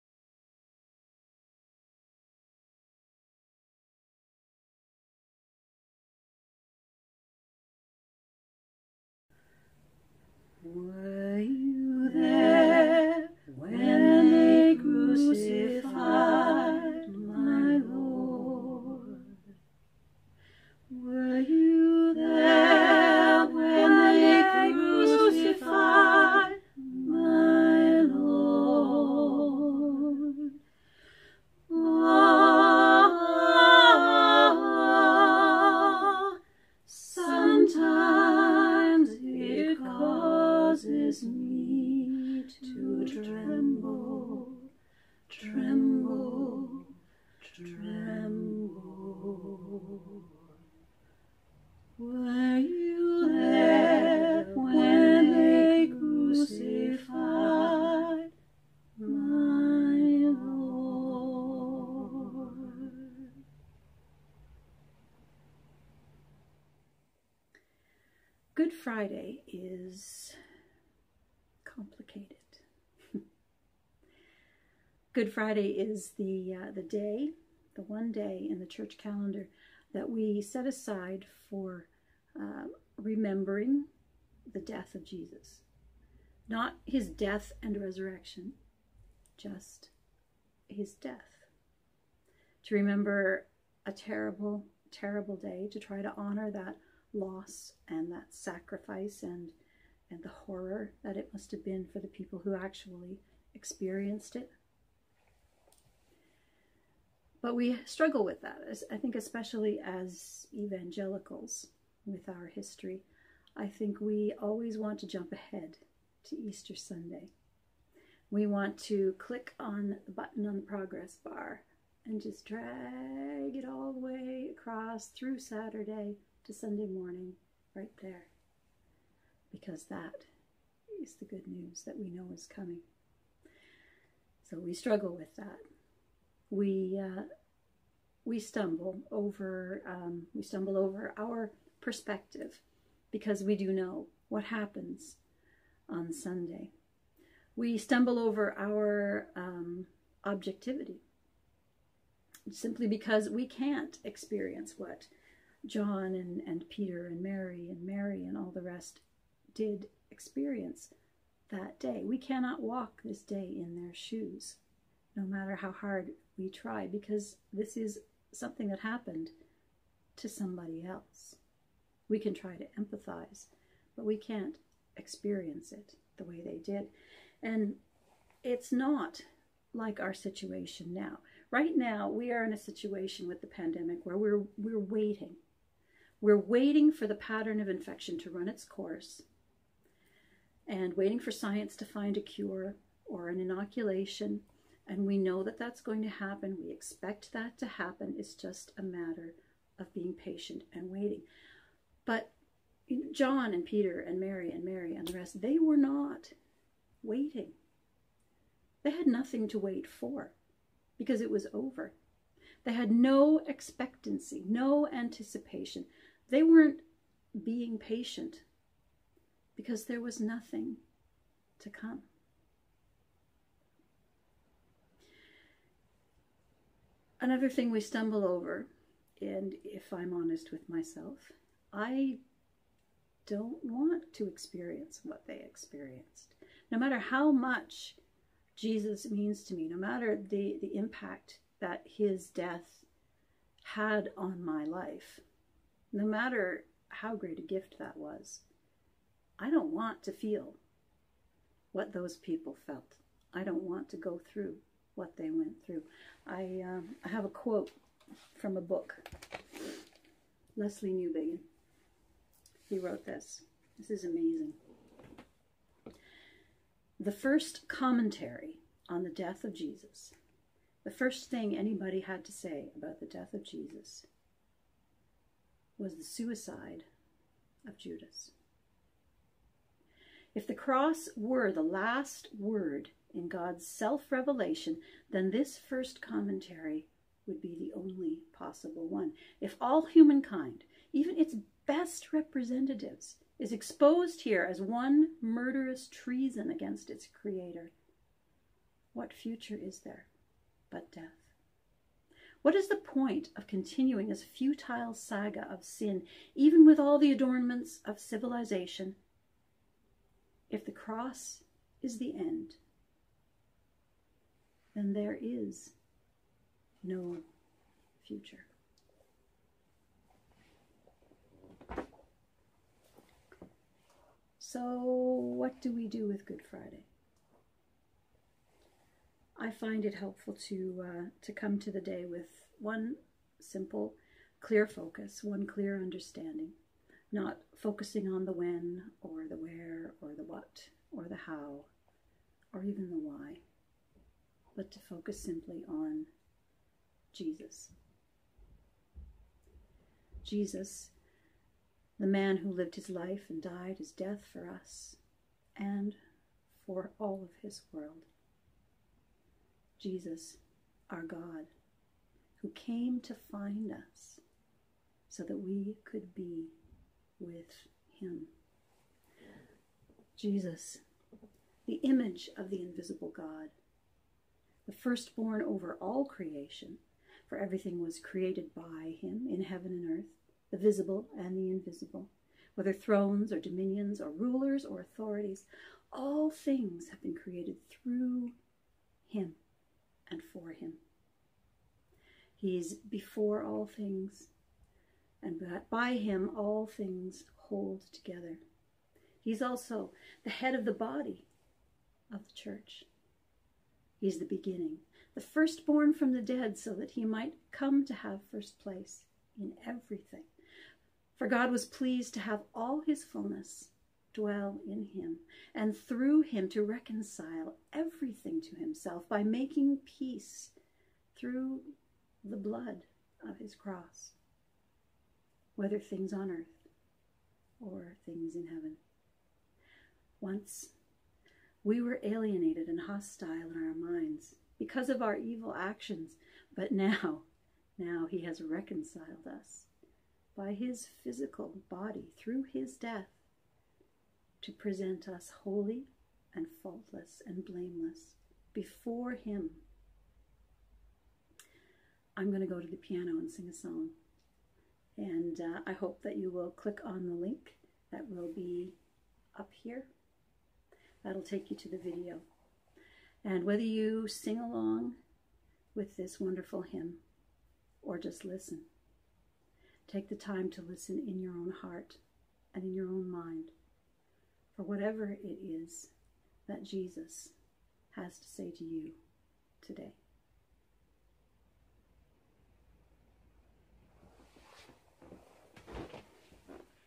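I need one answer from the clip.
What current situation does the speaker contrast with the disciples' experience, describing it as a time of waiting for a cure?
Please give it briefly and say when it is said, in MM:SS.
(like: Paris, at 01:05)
The pandemic, at 03:03.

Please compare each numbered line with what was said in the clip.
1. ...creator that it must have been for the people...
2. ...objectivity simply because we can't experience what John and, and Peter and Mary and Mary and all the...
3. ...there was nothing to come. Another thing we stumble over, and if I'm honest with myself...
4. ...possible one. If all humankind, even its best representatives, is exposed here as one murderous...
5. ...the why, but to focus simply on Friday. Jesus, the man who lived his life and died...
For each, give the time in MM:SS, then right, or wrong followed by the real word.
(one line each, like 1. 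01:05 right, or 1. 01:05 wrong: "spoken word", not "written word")
1. 01:40 wrong: "horror", not "creator"
2. 02:30 right
3. 03:39 right
4. 04:48 right
5. 05:42 wrong: "Jesus", not "Friday".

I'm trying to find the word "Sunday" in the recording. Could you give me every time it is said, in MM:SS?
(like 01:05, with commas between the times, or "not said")
01:56, 02:06, 02:26.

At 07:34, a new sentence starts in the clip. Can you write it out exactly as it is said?
And uh, I hope that you will click on the link that will be up here.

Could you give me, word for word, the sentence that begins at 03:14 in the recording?
And we know that that's going to happen.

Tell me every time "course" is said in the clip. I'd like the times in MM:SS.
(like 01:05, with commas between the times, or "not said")
03:08.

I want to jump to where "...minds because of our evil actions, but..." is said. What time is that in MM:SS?
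07:13.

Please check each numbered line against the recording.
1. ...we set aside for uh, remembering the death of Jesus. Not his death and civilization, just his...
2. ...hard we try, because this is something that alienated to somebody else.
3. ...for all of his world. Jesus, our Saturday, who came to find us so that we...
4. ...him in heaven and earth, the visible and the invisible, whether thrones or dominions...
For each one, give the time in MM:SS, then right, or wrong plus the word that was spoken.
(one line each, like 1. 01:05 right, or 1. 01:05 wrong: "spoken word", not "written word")
1. 01:20 wrong: "resurrection", not "civilization"
2. 02:45 wrong: "happened", not "alienated"
3. 05:56 wrong: "God", not "Saturday"
4. 06:19 right.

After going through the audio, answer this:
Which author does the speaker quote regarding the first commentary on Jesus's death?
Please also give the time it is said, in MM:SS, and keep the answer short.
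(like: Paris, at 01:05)
Lesslie Newbigin, at 04:20.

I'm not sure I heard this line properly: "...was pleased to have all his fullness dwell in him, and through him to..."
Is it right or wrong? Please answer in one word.
right.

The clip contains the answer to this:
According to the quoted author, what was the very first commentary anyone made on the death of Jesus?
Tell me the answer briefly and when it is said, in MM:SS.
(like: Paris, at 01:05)
The suicide of Judas, at 04:35.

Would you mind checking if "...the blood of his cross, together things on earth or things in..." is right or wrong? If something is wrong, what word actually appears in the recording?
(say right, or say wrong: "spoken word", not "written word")
wrong: "whether", not "together".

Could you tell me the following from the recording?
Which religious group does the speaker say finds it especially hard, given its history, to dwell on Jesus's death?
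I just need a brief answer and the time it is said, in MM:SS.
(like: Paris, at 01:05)
Evangelicals, at 01:50.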